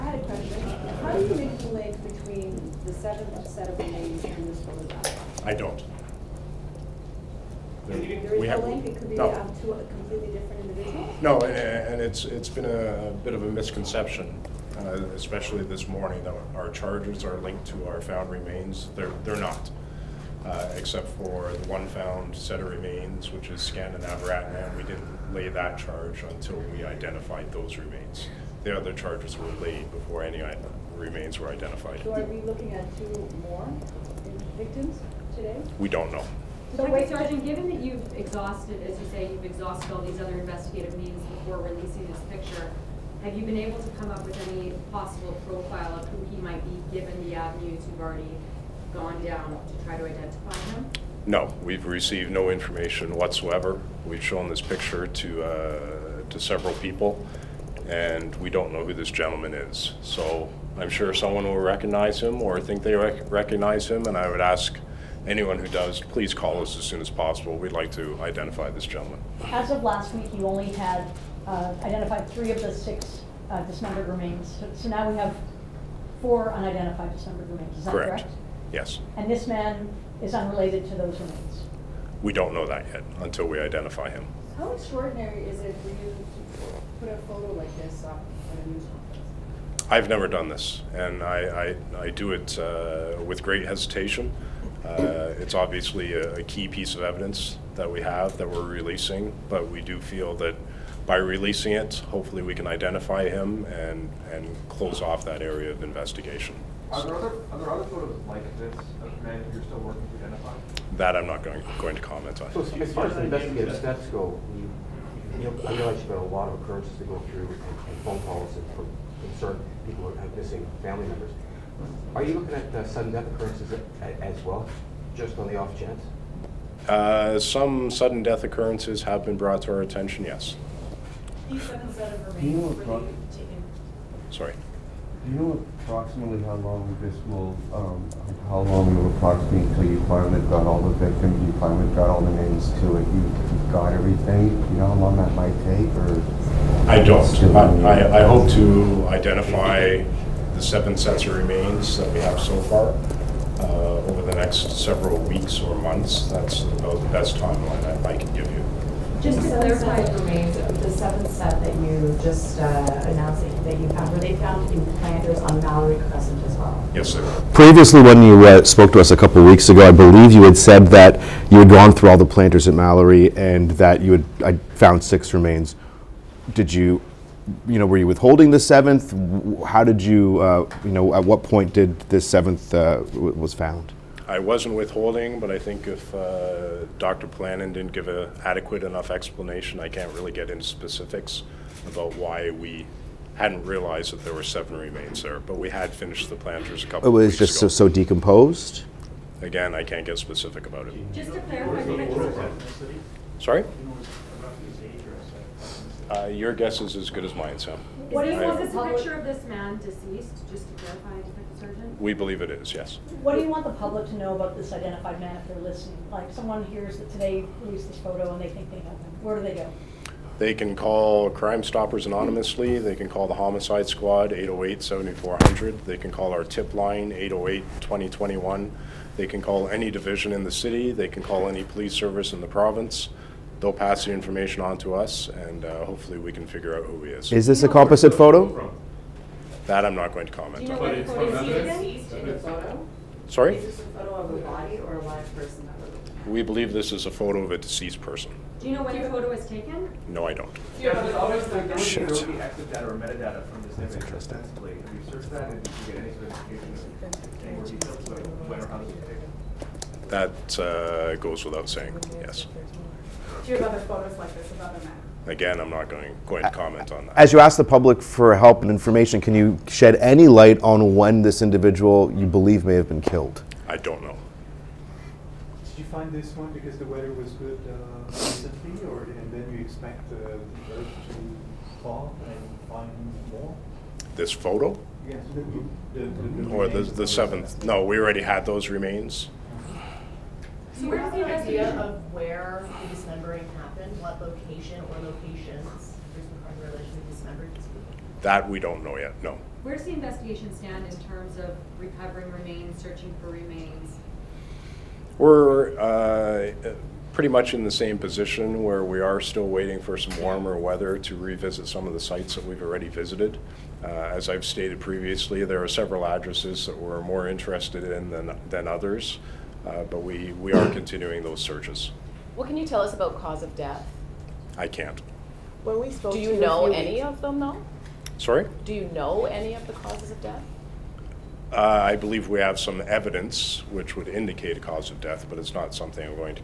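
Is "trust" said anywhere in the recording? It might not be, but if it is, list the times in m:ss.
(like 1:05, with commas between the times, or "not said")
not said.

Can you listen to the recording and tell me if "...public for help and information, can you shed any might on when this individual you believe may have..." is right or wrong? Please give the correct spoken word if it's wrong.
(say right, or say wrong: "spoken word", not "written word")
wrong: "light", not "might".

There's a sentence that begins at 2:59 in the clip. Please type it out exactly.
How did you, uh, you know, at what point did this seventh uh, was found?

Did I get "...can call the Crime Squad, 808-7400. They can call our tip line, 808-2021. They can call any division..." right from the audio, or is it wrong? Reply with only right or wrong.
wrong.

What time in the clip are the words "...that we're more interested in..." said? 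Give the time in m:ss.
5:16.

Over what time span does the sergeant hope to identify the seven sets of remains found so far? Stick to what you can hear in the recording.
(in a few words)
several weeks or months.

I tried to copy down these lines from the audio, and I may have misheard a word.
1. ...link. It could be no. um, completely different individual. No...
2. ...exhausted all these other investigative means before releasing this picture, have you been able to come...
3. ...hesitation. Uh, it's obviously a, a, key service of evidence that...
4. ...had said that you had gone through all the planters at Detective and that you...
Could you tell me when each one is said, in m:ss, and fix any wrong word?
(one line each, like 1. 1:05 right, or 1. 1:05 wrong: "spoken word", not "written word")
1. 0:08 right
2. 0:39 right
3. 1:33 wrong: "piece", not "service"
4. 2:50 wrong: "Mallory", not "Detective".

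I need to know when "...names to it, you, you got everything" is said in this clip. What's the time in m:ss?
2:22.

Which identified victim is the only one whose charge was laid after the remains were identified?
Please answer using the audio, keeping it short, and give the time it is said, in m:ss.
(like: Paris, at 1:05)
Skanda Navaratnam, at 0:23.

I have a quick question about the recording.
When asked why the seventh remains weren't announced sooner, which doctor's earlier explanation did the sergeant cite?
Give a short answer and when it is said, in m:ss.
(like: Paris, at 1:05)
Dr. Pollanen, at 3:06.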